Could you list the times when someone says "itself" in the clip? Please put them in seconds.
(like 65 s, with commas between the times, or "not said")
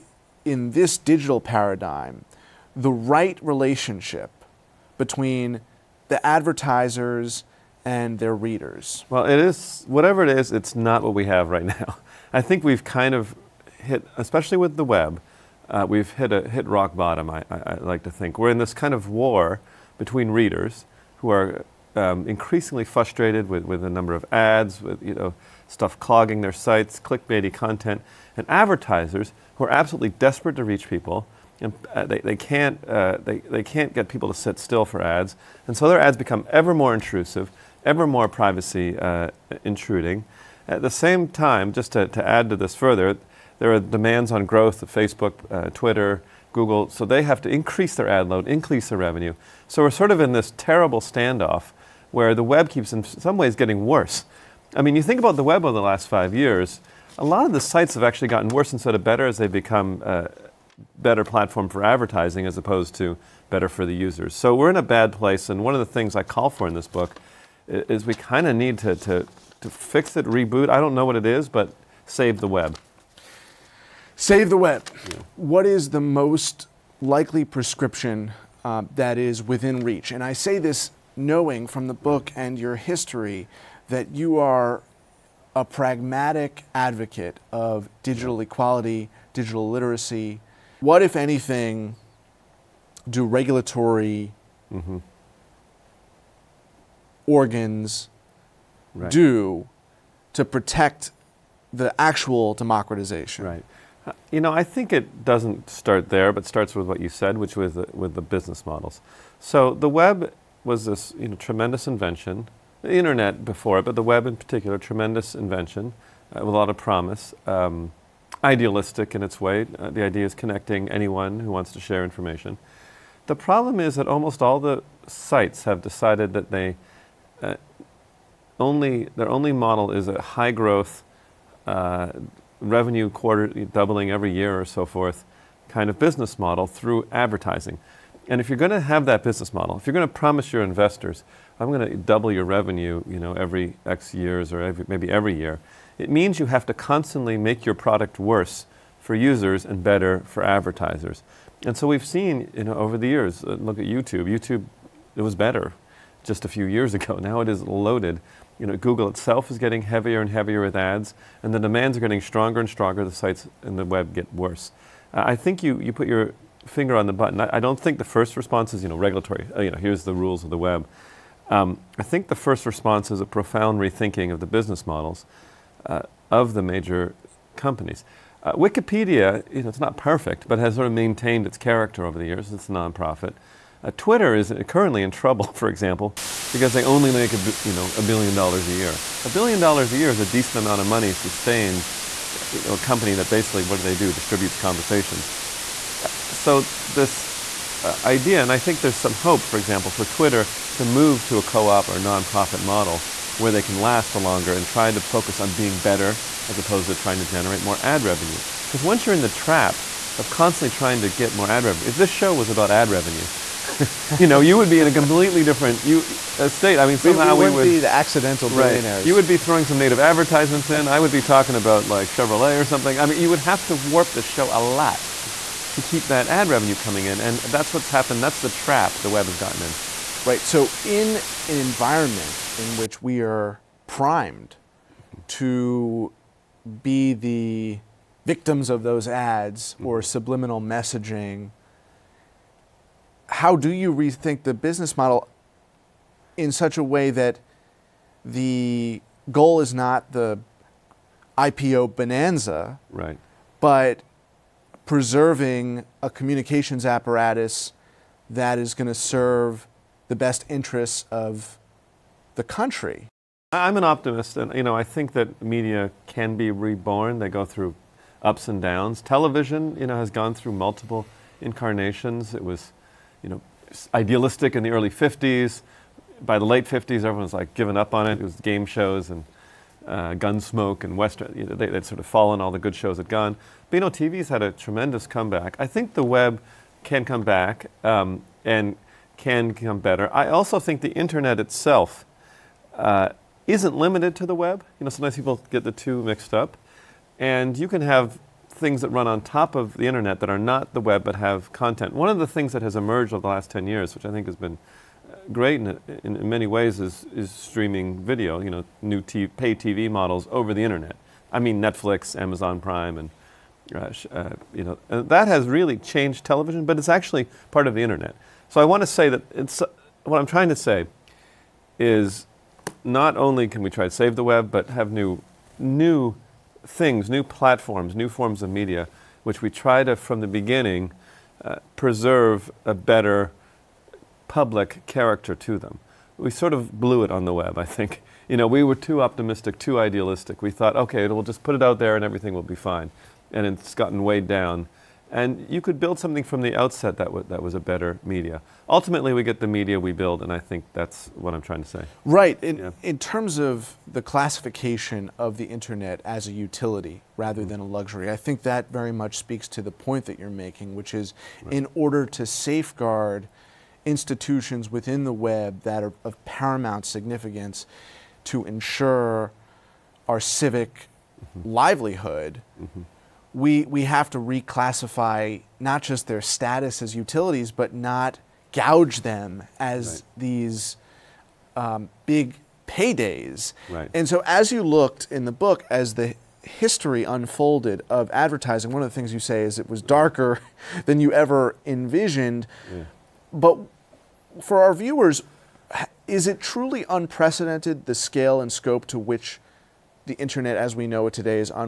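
159 s, 291 s.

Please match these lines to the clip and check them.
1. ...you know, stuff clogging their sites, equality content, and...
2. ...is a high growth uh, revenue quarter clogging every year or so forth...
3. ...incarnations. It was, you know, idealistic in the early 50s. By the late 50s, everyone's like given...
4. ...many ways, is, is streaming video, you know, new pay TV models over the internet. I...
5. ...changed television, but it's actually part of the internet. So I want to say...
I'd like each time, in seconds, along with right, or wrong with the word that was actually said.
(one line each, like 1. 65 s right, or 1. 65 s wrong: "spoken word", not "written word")
1. 25 s wrong: "clickbaity", not "equality"
2. 129 s wrong: "doubling", not "clogging"
3. 271 s right
4. 306 s right
5. 315 s right.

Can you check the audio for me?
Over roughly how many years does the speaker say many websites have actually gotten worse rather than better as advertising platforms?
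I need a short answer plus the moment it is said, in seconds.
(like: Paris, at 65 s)
5 years, at 56 s.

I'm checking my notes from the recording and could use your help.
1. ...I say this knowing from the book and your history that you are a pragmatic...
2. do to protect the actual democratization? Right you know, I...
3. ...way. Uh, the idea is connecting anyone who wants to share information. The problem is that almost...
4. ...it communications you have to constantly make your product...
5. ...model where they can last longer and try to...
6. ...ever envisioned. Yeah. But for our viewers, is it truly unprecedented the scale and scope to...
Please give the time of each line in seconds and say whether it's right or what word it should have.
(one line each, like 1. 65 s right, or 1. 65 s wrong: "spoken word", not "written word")
1. 80 s right
2. 99 s right
3. 119 s right
4. 145 s wrong: "means", not "communications"
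5. 202 s right
6. 391 s right.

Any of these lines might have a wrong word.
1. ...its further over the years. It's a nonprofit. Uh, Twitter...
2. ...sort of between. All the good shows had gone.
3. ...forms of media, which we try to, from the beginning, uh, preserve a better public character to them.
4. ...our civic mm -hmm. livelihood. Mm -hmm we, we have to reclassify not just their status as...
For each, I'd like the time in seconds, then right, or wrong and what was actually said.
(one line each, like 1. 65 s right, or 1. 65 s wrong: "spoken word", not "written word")
1. 181 s wrong: "character", not "further"
2. 281 s wrong: "fallen", not "between"
3. 328 s right
4. 370 s right.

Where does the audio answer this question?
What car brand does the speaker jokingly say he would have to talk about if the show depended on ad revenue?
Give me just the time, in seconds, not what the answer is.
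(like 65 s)
222 s.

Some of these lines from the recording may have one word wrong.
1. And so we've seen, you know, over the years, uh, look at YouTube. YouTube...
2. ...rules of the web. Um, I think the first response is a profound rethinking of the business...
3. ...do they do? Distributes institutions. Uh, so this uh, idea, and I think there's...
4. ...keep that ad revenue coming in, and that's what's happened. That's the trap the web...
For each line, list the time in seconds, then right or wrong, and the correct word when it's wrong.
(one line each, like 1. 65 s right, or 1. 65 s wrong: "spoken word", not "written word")
1. 151 s right
2. 170 s right
3. 193 s wrong: "conversations", not "institutions"
4. 225 s right.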